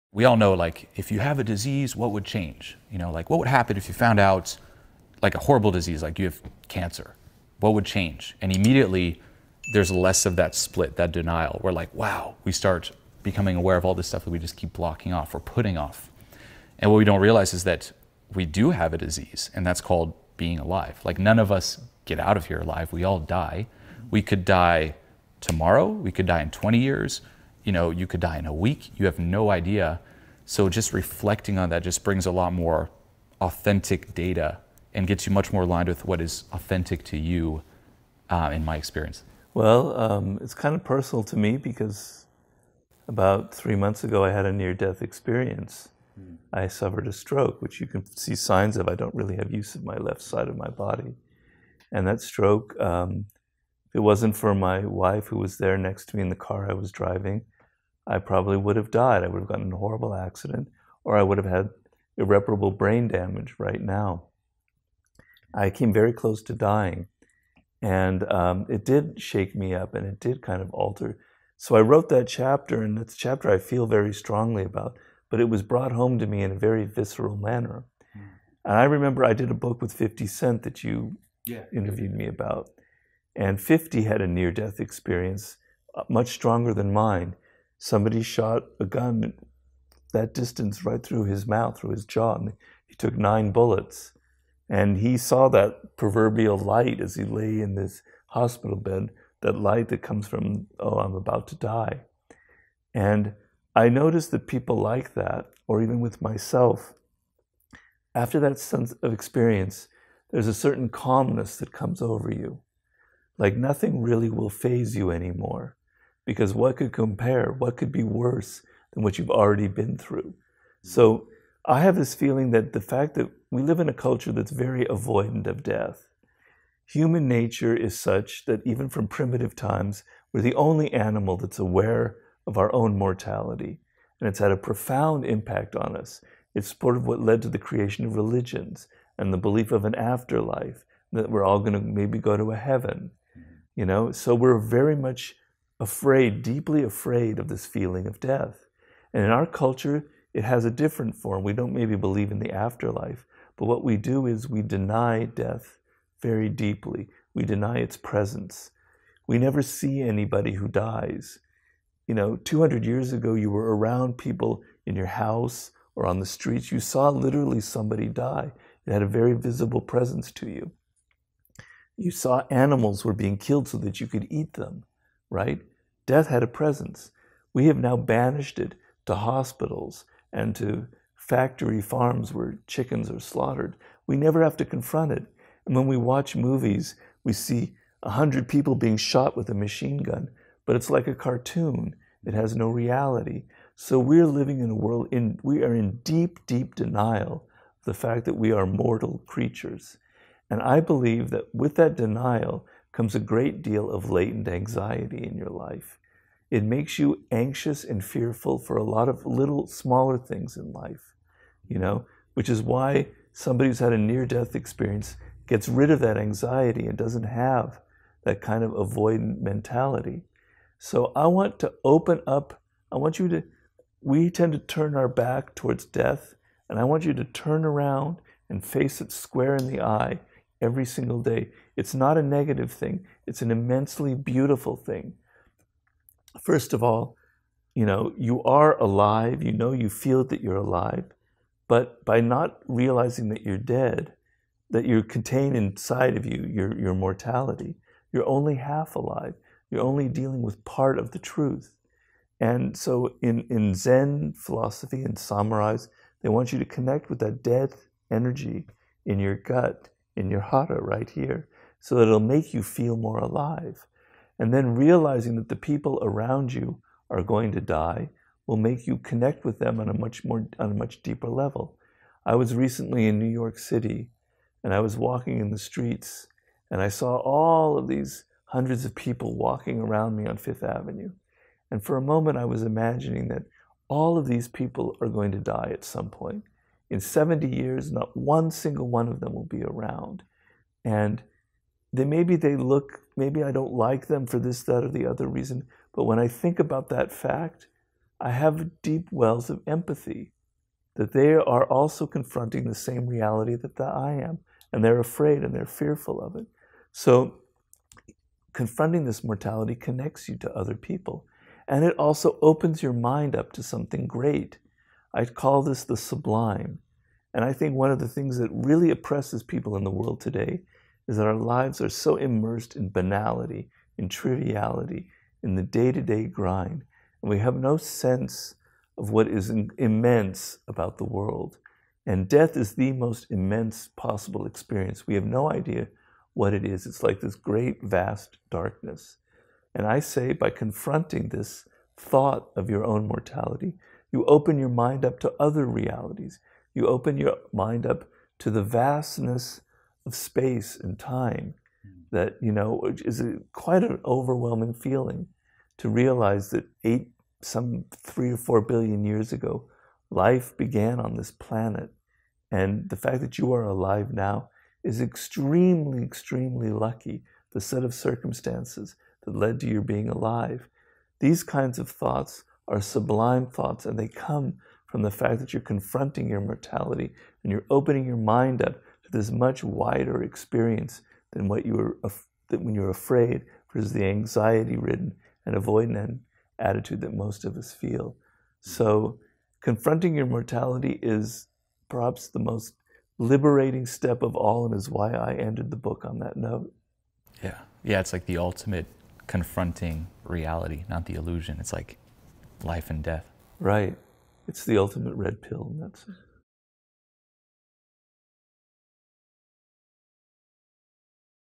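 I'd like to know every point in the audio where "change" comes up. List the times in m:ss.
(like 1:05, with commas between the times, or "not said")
0:02, 0:07.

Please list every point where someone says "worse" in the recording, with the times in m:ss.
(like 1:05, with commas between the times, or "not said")
1:58.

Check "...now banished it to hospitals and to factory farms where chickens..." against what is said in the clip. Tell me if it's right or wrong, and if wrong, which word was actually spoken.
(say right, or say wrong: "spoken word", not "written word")
right.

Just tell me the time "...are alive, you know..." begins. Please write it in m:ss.
3:58.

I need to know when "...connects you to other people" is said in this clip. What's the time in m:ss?
5:09.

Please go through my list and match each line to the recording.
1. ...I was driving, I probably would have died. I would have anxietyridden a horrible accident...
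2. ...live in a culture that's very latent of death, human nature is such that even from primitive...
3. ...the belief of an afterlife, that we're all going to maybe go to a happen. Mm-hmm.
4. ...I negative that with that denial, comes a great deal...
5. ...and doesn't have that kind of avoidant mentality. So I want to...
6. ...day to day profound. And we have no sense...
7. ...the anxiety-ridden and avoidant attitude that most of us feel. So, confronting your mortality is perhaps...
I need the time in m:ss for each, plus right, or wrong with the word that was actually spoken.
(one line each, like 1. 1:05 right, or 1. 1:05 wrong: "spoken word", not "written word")
1. 0:56 wrong: "gotten", not "anxietyridden"
2. 2:03 wrong: "avoidant", not "latent"
3. 2:19 wrong: "heaven", not "happen"
4. 3:20 wrong: "believe", not "negative"
5. 3:36 right
6. 5:25 wrong: "grind", not "profound"
7. 6:23 right.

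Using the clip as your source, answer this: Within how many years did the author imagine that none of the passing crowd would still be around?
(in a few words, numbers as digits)
70.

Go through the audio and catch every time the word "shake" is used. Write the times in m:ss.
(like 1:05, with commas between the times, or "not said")
1:09.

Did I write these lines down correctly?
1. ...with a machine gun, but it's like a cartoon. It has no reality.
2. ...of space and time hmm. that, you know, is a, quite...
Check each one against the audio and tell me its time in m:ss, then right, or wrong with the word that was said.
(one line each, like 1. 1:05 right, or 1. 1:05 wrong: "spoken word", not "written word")
1. 3:09 right
2. 5:50 right.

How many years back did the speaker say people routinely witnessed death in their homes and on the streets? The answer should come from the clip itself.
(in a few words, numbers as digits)
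200.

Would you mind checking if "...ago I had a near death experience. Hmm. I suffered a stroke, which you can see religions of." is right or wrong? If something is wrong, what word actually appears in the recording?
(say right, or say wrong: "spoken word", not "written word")
wrong: "signs", not "religions".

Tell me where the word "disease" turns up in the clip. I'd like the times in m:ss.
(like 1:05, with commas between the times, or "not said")
0:01, 0:05, 0:18.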